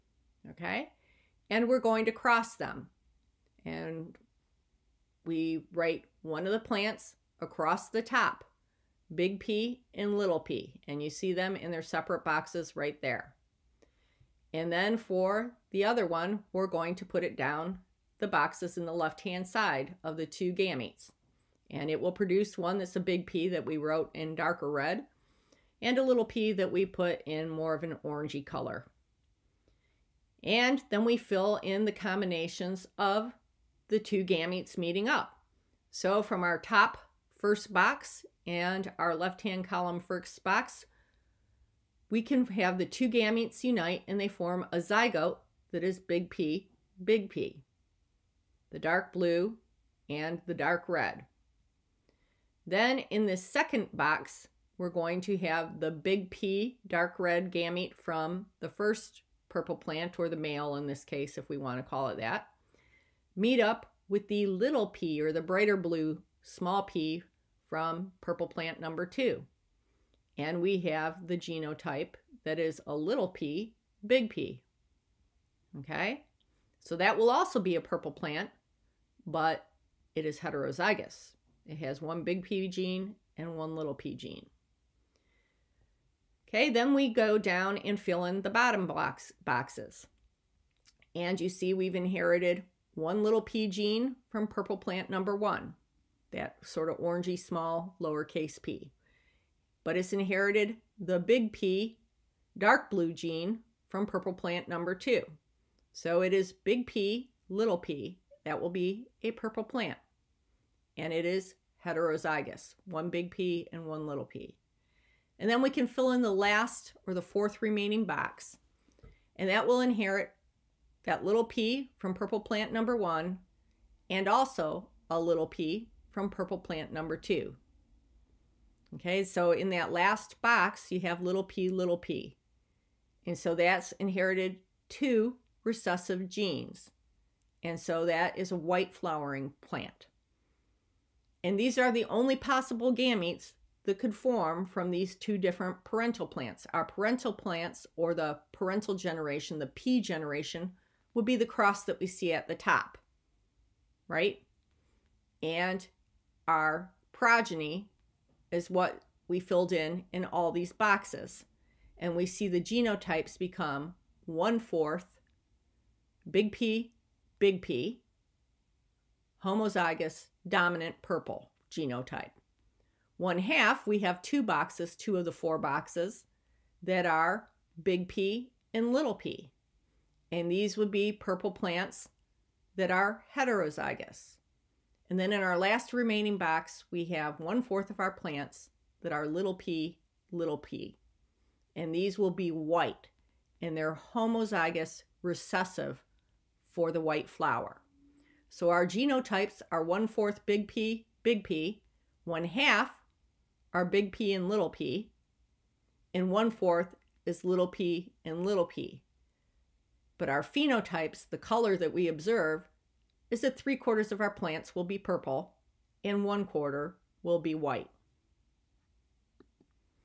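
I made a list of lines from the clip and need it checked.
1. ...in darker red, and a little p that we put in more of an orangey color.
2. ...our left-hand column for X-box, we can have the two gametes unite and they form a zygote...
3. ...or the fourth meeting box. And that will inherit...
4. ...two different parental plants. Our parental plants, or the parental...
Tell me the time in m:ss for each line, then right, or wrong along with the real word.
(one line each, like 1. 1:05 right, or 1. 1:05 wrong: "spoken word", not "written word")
1. 0:24 right
2. 0:38 right
3. 1:57 wrong: "remaining", not "meeting"
4. 2:25 right.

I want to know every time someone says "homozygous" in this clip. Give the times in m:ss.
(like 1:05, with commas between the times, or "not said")
2:49, 3:14.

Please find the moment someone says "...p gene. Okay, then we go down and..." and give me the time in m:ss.
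1:23.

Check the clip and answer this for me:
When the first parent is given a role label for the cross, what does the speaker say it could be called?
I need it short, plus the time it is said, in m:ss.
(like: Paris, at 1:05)
the male, at 1:00.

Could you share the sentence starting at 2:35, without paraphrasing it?
And our progeny is what we filled in in all these boxes.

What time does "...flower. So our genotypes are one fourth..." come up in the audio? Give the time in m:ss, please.
3:17.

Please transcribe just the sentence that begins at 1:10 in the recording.
And we have the genotype that is a little p, big P.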